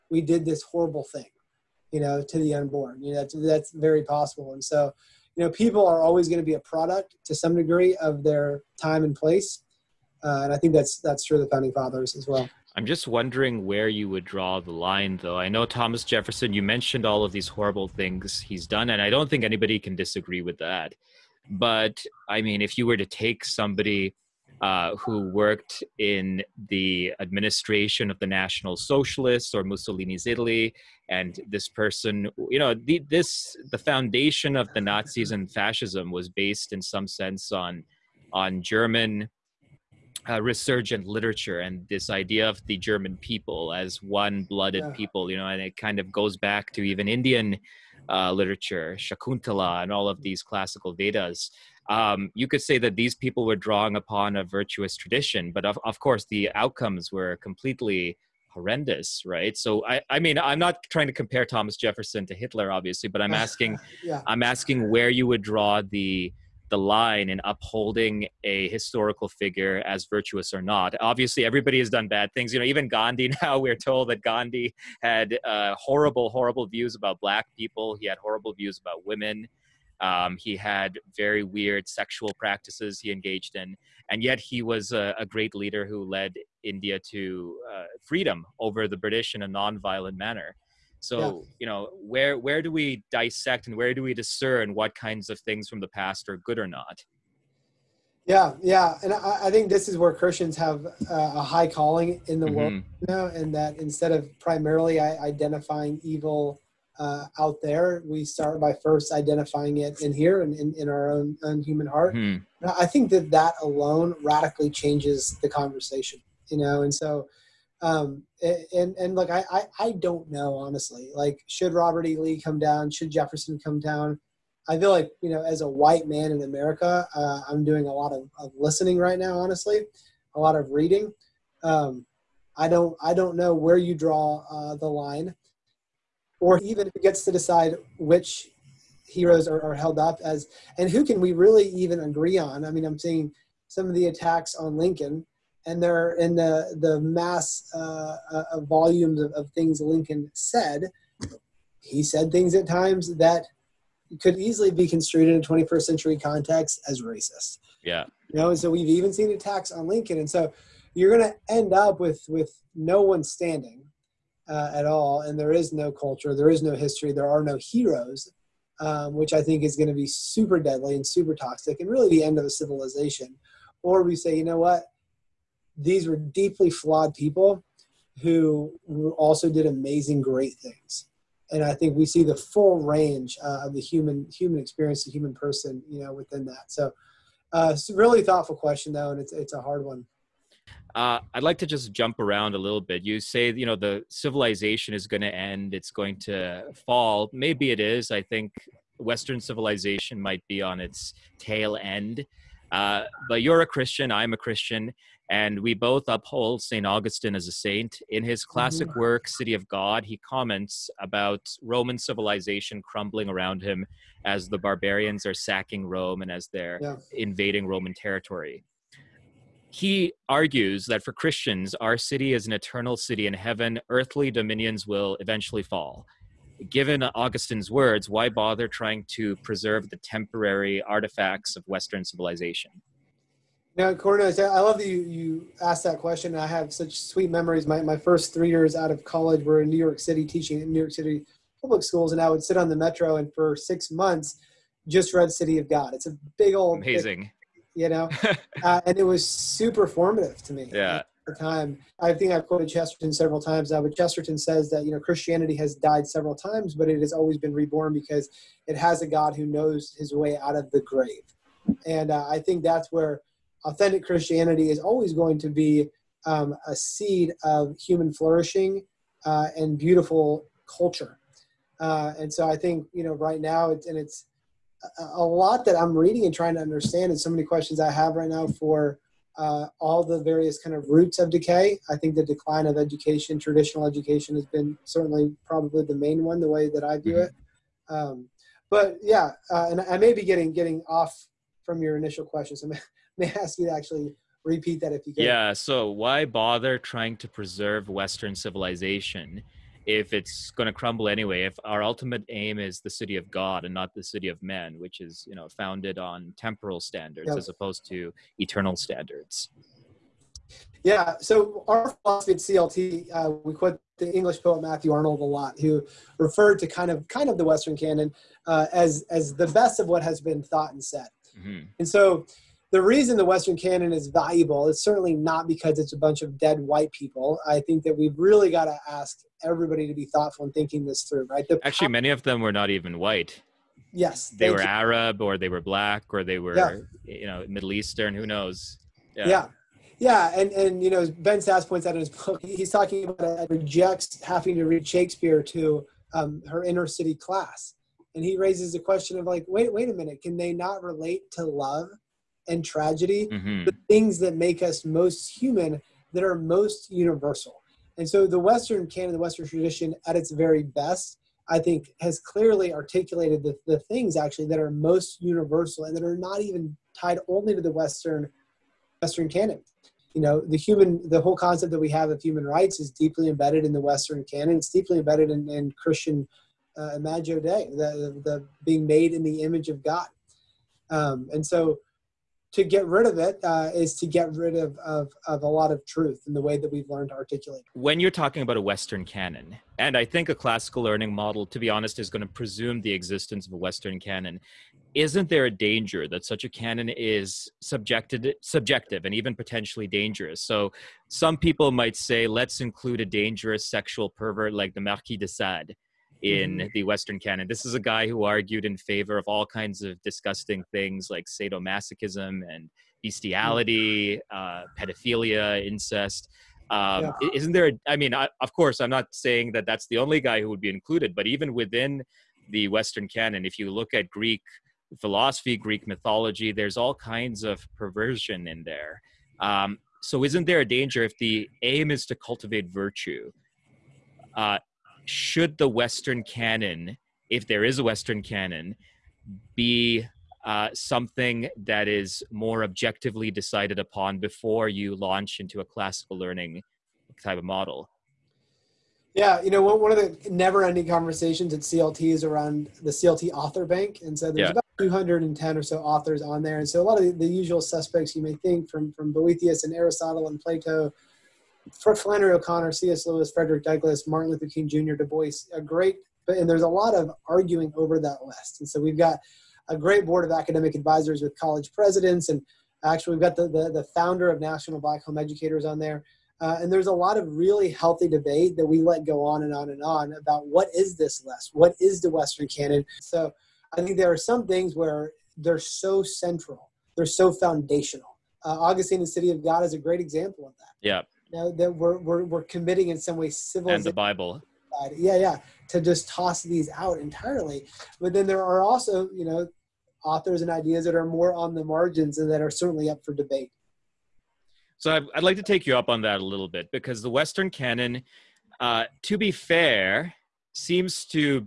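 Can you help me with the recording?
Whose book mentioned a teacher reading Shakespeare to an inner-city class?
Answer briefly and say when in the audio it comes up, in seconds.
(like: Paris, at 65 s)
Ben Sasse, at 341 s.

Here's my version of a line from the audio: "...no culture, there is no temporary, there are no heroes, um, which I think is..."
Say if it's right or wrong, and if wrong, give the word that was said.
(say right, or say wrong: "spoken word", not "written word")
wrong: "history", not "temporary".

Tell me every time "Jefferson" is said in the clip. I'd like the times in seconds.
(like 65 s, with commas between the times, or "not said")
16 s, 61 s, 123 s.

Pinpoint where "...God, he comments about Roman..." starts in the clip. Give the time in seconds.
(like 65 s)
209 s.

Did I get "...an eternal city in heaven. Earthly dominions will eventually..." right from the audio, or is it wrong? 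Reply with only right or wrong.
right.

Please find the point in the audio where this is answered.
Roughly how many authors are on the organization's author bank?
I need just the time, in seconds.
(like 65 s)
454 s.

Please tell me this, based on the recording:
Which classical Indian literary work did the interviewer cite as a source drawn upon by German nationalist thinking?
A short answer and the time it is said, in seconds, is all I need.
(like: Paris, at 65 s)
Shakuntala, at 48 s.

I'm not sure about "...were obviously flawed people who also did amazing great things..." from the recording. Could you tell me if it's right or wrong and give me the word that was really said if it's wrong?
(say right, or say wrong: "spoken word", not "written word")
wrong: "deeply", not "obviously".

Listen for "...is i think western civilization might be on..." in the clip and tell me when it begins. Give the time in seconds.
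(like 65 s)
197 s.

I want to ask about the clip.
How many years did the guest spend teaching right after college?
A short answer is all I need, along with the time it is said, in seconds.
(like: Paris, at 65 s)
3, at 238 s.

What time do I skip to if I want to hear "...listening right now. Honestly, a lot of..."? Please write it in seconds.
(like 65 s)
128 s.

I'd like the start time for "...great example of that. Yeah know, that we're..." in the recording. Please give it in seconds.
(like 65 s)
489 s.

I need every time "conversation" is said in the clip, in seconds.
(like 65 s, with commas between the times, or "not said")
115 s, 450 s.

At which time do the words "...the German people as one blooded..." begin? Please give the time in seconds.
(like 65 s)
42 s.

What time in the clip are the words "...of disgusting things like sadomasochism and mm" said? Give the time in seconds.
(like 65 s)
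409 s.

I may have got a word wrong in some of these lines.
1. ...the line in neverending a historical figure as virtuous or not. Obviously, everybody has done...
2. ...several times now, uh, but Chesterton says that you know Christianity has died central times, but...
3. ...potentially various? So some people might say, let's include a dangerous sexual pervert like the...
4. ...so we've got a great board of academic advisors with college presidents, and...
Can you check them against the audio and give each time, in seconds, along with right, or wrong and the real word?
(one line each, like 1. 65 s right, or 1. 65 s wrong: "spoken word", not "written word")
1. 66 s wrong: "upholding", not "neverending"
2. 253 s wrong: "several", not "central"
3. 399 s wrong: "dangerous", not "various"
4. 468 s right.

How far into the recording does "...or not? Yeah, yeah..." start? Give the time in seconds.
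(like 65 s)
96 s.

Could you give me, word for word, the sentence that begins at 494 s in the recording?
Yeah, yeah, to just toss these out entirely.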